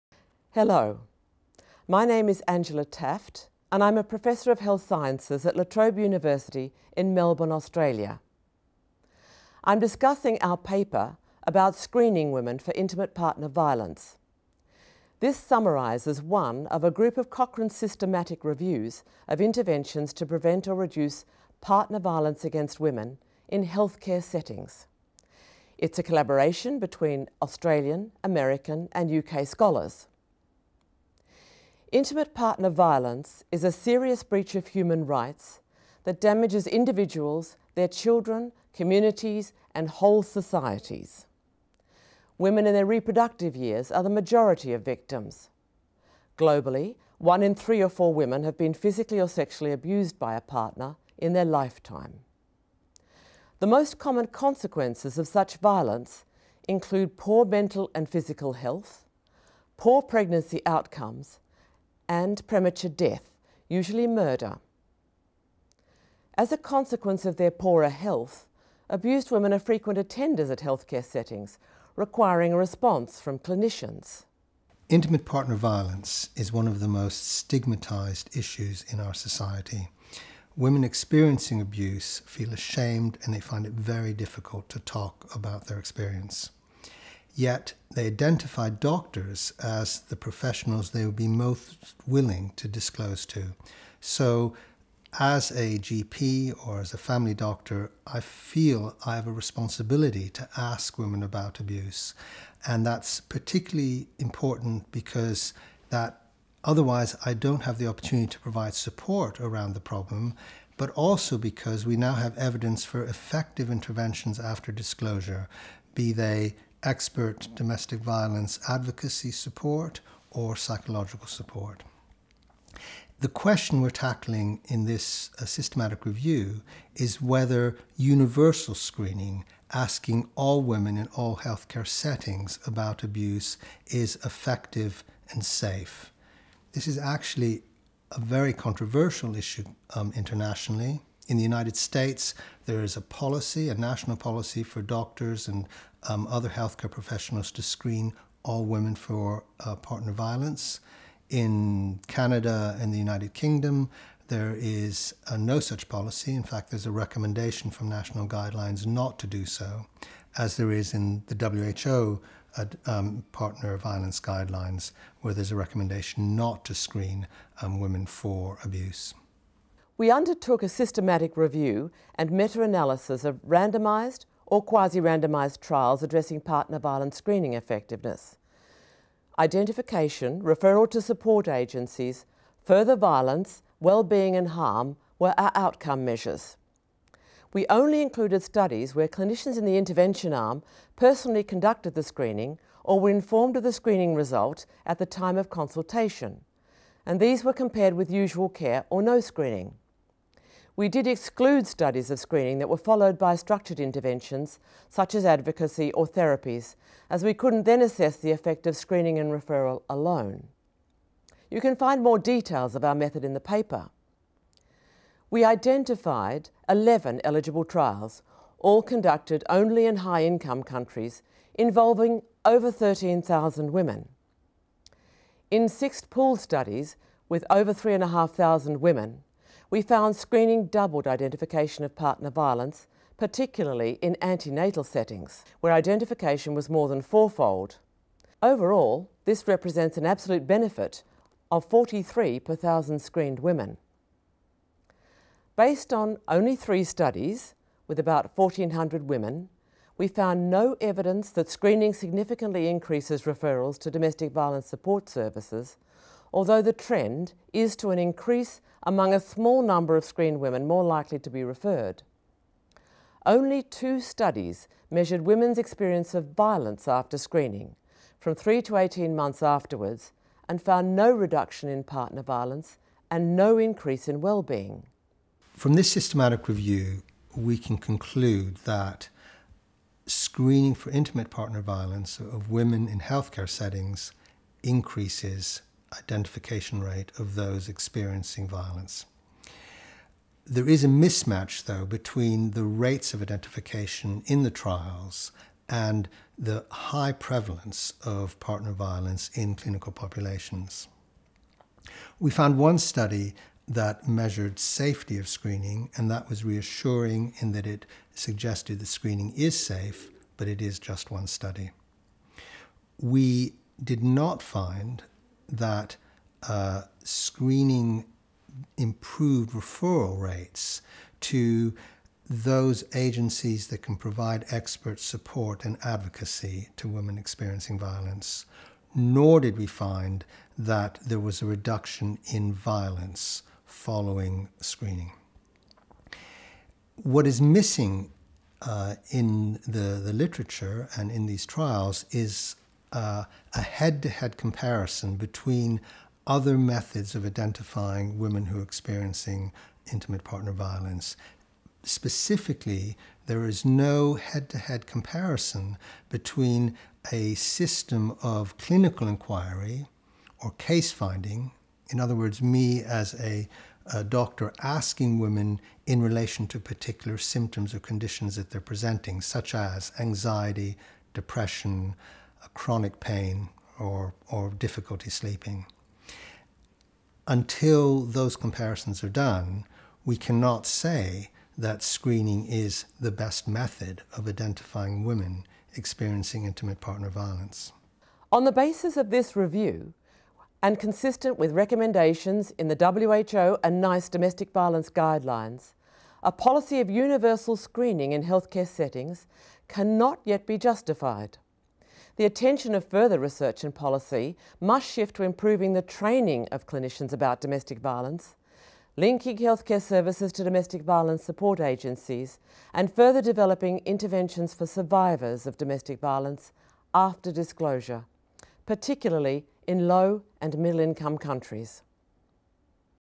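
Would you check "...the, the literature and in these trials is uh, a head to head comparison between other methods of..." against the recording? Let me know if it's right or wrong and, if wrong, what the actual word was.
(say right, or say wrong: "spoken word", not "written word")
right.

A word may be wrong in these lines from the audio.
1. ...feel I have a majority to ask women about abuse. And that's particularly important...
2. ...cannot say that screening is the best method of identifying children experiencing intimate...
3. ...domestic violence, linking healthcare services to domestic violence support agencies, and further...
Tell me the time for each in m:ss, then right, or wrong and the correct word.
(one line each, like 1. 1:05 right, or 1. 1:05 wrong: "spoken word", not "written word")
1. 1:38 wrong: "responsibility", not "majority"
2. 6:20 wrong: "women", not "children"
3. 6:47 right.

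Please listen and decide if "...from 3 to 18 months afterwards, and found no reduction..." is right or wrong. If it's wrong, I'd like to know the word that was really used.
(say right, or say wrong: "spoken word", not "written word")
right.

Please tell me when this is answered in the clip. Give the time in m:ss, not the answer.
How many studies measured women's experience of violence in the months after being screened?
4:23.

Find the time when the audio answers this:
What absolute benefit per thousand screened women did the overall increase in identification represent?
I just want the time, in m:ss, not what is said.
4:01.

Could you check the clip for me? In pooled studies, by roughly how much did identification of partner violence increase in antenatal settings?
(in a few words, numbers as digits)
more than fourfold.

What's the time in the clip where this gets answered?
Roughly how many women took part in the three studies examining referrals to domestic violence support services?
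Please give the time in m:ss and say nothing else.
4:07.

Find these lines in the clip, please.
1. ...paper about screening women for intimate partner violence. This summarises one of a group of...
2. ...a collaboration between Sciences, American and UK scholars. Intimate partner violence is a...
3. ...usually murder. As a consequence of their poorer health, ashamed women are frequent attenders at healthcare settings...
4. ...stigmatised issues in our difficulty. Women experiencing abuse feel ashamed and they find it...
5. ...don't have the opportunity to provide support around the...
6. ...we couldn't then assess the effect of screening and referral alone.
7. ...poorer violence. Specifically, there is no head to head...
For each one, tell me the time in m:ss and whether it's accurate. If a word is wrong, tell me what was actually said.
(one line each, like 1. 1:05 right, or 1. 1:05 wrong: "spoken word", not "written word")
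1. 0:10 right
2. 0:25 wrong: "Australian", not "Sciences"
3. 1:03 wrong: "abused", not "ashamed"
4. 1:17 wrong: "society", not "difficulty"
5. 1:47 right
6. 3:27 right
7. 5:50 wrong: "partner", not "poorer".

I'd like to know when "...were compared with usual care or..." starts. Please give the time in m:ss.
3:17.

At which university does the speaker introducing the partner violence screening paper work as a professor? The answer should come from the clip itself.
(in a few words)
La Trobe University.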